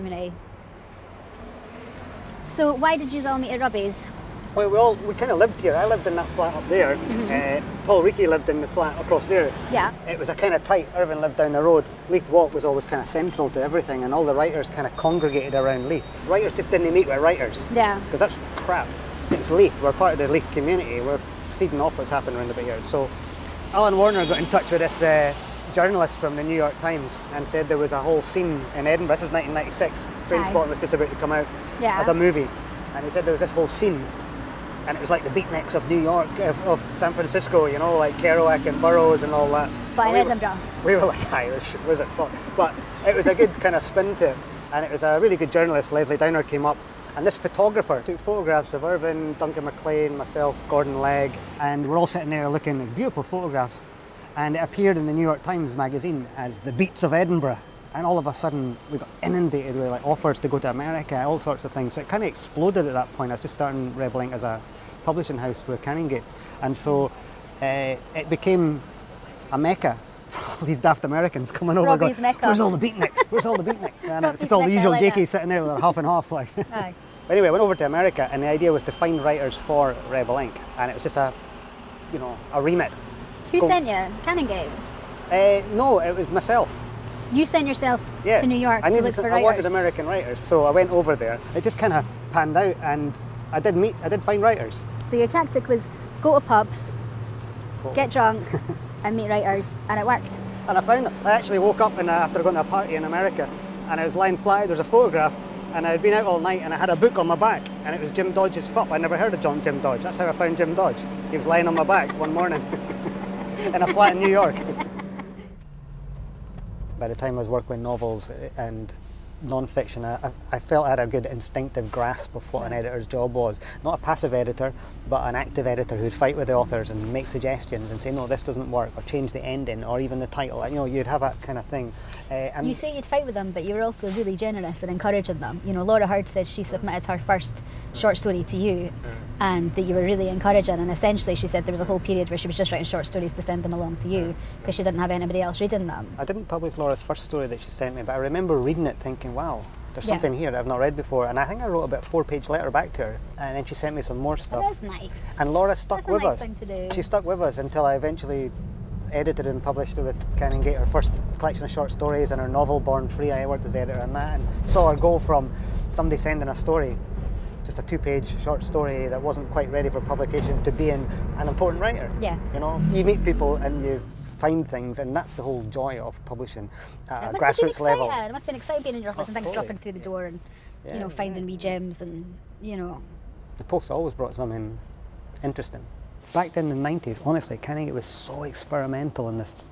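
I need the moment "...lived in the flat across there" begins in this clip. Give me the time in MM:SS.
00:08.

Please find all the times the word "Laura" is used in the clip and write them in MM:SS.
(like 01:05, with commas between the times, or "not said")
02:15, 02:26, 02:35.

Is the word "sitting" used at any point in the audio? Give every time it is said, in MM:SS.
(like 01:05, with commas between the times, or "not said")
00:52, 01:15.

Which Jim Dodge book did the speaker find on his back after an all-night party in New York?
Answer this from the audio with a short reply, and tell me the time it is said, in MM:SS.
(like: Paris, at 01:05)
Fup, at 01:48.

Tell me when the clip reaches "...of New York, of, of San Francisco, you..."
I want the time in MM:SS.
00:35.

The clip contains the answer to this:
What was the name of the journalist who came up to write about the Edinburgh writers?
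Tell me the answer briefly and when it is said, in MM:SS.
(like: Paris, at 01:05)
Lesley Downer, at 00:45.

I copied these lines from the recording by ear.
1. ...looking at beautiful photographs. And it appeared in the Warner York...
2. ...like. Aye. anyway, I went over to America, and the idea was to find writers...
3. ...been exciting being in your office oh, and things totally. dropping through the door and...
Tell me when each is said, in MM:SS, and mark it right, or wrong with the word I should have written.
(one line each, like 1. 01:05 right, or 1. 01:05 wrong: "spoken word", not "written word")
1. 00:52 wrong: "New", not "Warner"
2. 01:16 right
3. 02:58 right.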